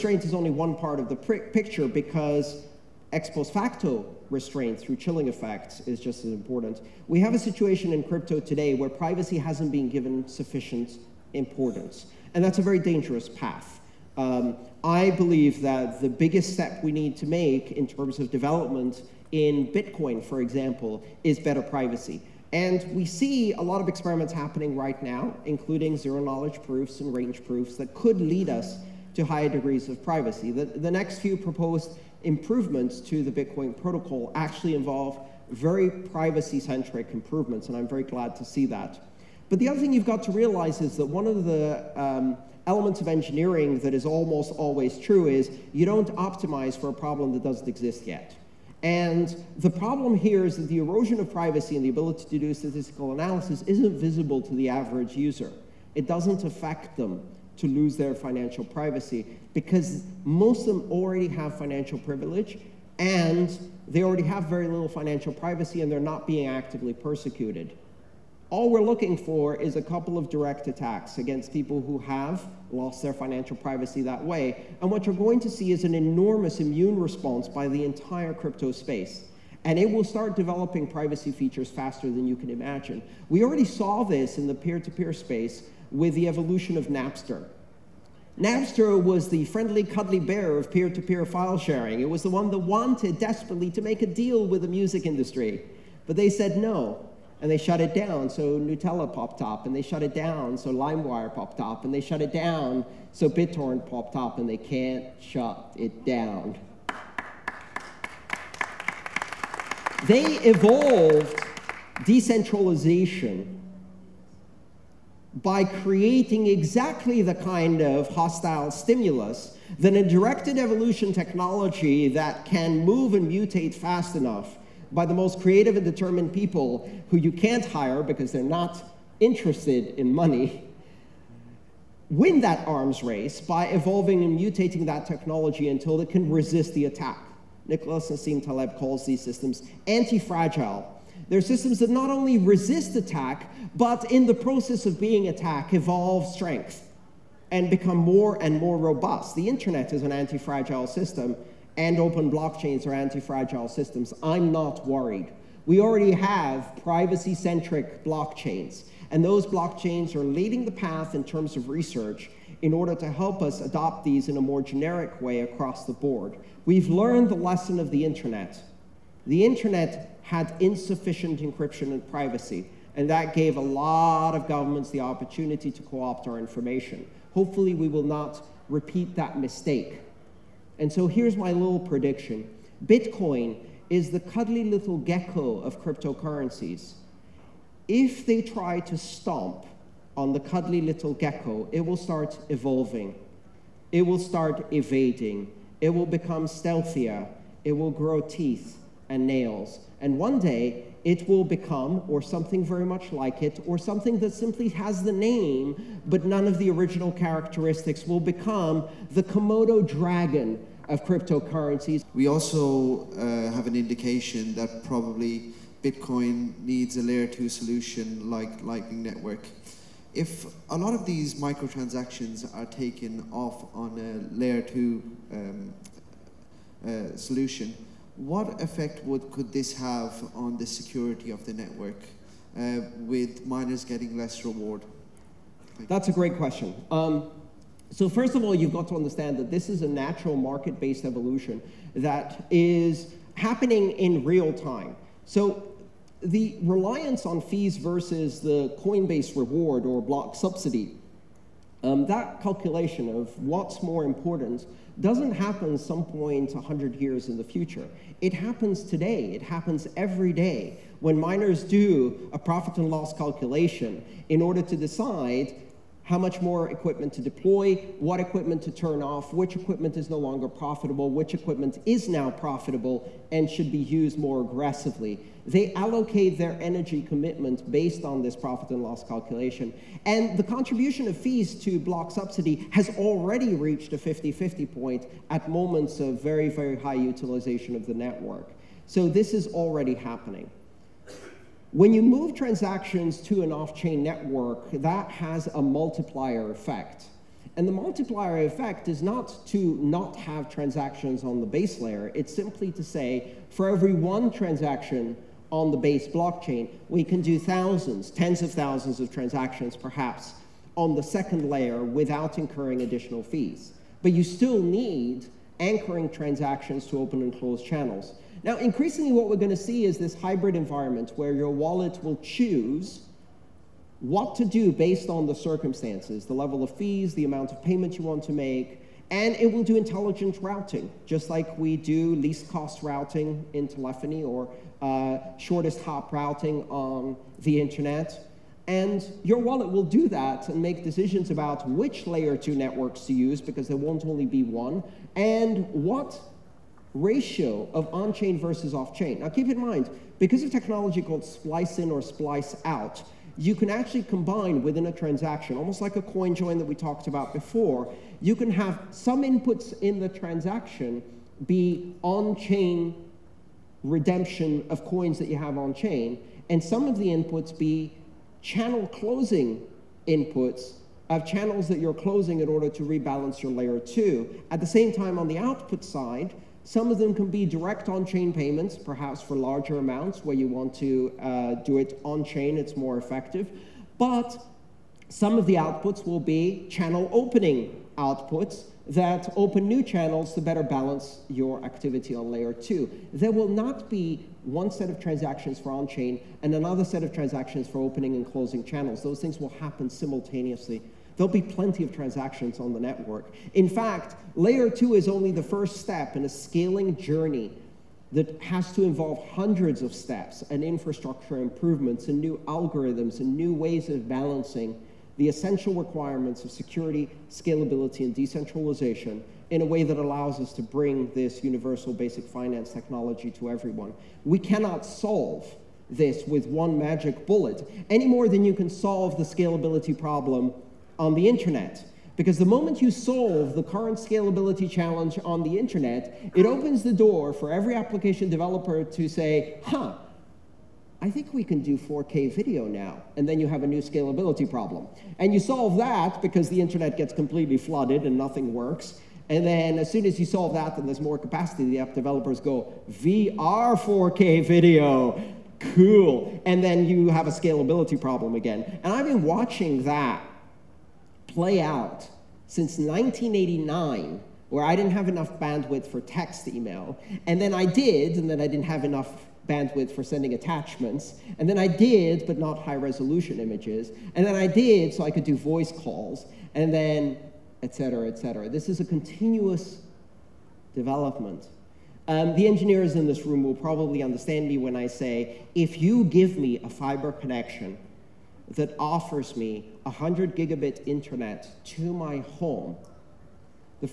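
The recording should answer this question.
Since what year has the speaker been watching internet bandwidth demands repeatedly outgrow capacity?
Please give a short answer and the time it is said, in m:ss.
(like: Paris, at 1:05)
1989, at 7:42.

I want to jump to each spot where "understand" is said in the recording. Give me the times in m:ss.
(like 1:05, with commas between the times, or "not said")
3:58, 8:04.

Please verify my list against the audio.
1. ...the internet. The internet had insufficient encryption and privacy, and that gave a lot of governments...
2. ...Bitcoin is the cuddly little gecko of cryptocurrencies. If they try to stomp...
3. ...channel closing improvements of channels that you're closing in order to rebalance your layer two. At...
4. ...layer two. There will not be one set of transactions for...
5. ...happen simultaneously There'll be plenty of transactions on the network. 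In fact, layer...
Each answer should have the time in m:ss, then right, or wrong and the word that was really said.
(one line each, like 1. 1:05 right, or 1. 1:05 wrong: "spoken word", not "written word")
1. 2:47 right
2. 3:02 right
3. 6:08 wrong: "inputs", not "improvements"
4. 6:32 right
5. 6:39 right.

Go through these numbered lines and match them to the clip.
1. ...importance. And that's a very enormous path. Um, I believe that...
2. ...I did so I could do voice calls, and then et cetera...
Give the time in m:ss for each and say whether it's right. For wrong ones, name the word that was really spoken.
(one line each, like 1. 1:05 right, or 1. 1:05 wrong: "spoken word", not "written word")
1. 0:11 wrong: "dangerous", not "enormous"
2. 7:54 right.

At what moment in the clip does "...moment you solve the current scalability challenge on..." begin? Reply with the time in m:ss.
7:12.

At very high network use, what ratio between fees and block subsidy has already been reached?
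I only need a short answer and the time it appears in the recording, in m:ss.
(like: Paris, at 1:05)
50-50, at 4:43.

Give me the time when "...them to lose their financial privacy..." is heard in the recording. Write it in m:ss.
0:56.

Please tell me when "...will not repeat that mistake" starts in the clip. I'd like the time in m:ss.
2:57.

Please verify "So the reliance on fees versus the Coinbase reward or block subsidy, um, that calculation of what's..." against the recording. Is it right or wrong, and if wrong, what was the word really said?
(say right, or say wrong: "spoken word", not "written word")
right.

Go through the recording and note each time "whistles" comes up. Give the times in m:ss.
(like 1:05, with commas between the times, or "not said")
not said.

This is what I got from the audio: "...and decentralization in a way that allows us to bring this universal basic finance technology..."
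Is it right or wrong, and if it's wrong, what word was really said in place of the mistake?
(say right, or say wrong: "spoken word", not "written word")
right.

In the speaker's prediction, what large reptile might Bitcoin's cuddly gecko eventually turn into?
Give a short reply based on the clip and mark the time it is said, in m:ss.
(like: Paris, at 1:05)
Komodo dragon, at 3:29.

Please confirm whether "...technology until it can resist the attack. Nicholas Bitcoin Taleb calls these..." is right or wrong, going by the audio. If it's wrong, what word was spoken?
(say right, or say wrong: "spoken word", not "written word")
wrong: "Nassim", not "Bitcoin".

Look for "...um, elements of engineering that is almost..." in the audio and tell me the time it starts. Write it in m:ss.
0:42.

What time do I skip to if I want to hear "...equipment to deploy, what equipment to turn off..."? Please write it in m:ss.
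4:26.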